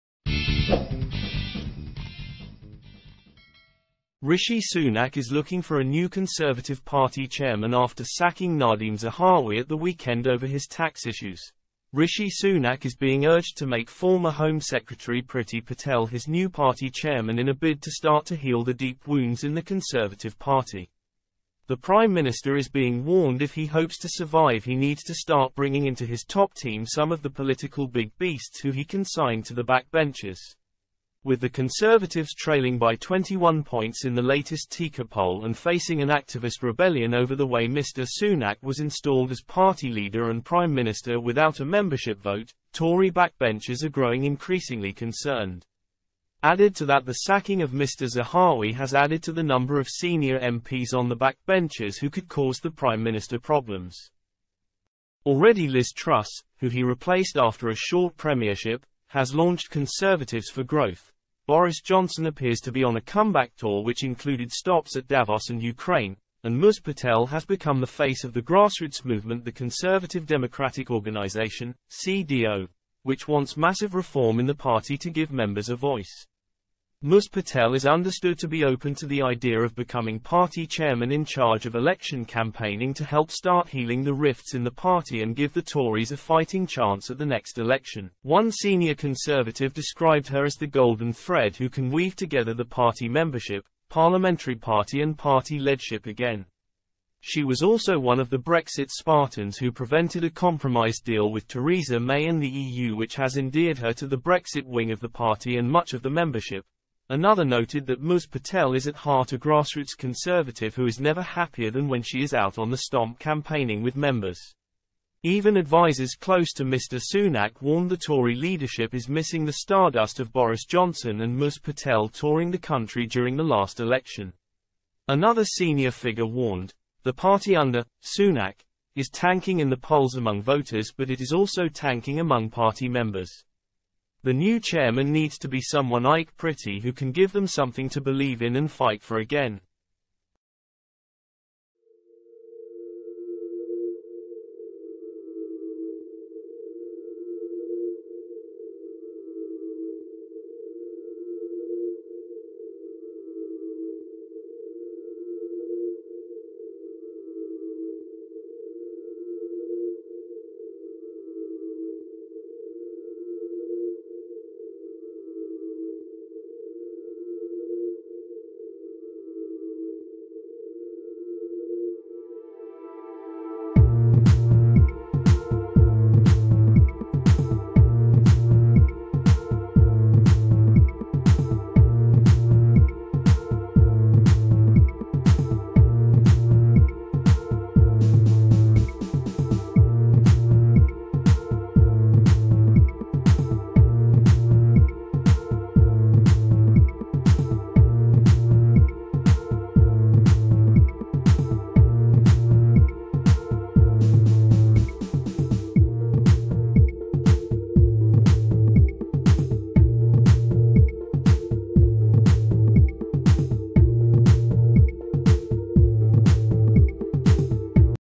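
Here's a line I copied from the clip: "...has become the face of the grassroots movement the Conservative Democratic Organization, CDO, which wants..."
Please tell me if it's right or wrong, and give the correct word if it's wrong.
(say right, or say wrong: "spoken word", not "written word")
right.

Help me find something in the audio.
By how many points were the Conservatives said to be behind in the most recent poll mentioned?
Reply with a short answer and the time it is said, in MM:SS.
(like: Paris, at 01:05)
21, at 00:32.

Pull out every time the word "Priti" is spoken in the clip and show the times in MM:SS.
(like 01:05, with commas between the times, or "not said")
00:15, 02:16.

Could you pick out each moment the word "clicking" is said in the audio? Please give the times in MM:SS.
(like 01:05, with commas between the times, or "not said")
not said.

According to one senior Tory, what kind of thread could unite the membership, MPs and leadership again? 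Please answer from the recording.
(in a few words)
golden thread.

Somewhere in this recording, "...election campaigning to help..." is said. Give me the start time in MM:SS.
01:21.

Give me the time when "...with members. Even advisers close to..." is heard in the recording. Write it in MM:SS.
01:53.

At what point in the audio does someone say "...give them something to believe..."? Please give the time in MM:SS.
02:17.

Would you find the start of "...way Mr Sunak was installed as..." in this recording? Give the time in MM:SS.
00:37.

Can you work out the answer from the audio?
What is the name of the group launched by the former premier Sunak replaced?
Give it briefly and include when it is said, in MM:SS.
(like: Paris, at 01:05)
Conservatives for Growth, at 00:59.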